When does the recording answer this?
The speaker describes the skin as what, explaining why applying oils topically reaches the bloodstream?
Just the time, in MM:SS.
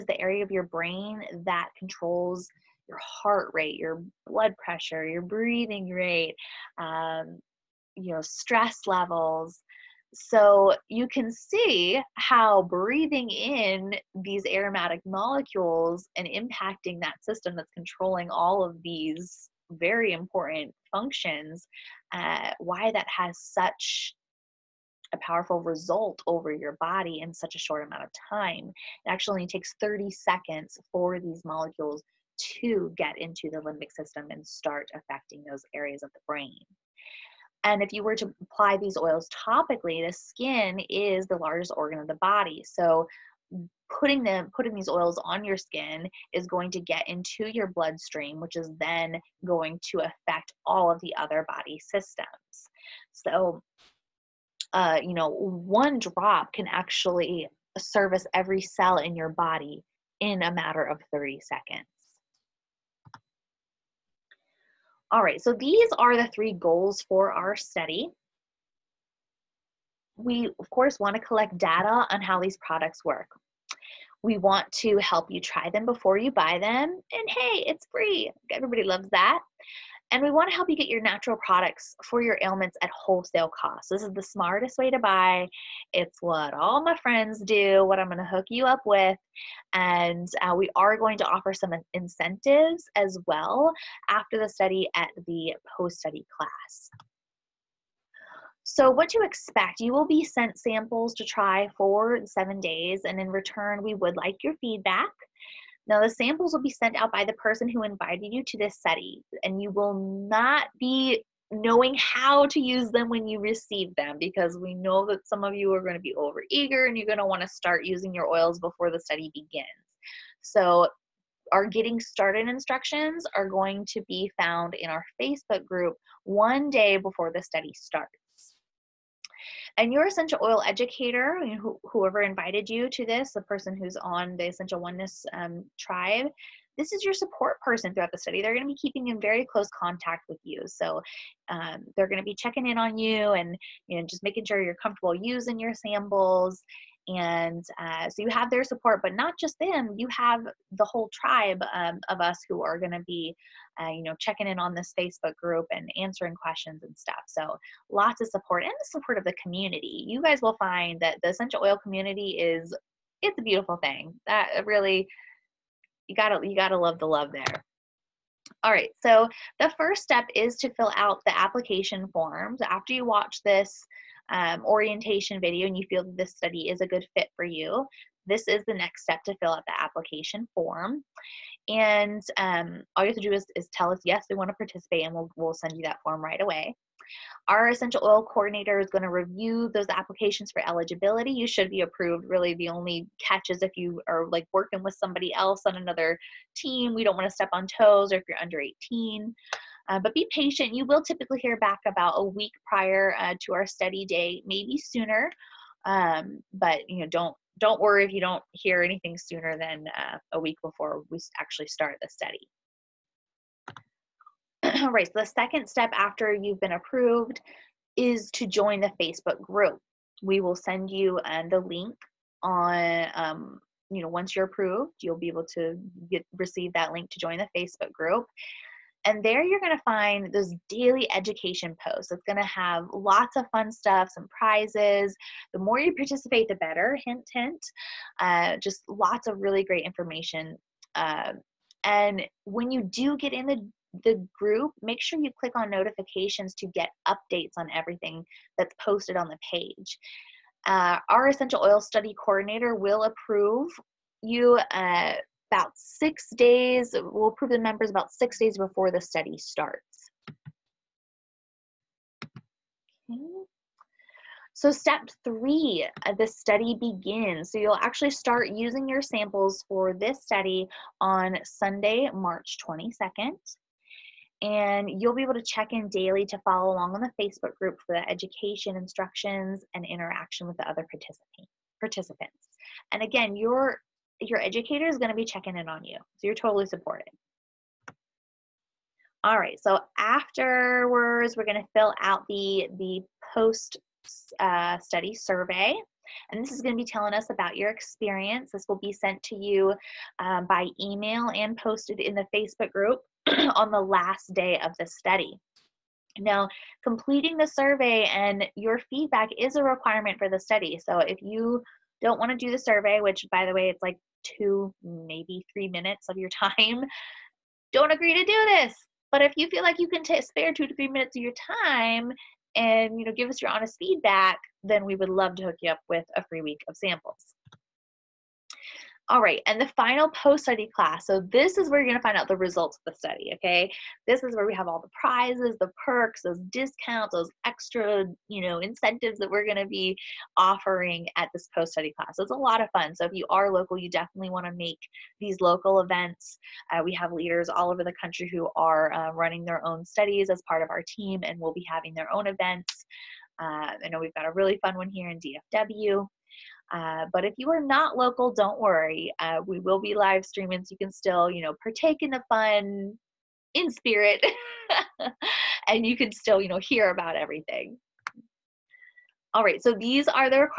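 00:41.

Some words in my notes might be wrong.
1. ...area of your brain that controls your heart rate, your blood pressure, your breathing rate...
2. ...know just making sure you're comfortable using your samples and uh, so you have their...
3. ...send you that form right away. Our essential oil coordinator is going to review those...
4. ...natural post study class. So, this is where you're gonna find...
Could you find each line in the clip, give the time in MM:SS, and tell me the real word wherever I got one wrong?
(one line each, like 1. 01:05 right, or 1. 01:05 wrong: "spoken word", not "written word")
1. 00:00 right
2. 02:23 right
3. 03:05 right
4. 05:29 wrong: "final", not "natural".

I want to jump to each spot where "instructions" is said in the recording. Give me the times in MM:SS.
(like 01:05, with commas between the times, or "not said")
02:02, 04:38.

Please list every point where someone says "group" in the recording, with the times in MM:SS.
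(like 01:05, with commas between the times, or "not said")
02:05, 02:35, 03:39, 03:47, 04:04, 04:37, 05:02.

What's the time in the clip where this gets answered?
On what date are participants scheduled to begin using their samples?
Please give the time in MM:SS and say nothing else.
04:31.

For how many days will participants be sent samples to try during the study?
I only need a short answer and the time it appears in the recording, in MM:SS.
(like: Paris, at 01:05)
7, at 01:42.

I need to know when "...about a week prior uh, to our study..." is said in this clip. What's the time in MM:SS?
03:21.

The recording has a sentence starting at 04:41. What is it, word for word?
Participants, and again, your your educator is going to be checking in on you.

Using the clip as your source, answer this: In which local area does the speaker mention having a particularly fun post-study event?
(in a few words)
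DFW.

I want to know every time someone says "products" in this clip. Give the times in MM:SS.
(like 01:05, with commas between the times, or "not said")
01:12, 01:21.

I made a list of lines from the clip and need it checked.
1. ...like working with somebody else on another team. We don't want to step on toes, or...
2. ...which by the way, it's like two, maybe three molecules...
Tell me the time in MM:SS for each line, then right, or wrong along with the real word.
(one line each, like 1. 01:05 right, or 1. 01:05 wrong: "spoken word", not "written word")
1. 03:14 right
2. 05:13 wrong: "minutes", not "molecules".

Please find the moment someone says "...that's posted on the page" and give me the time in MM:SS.
04:08.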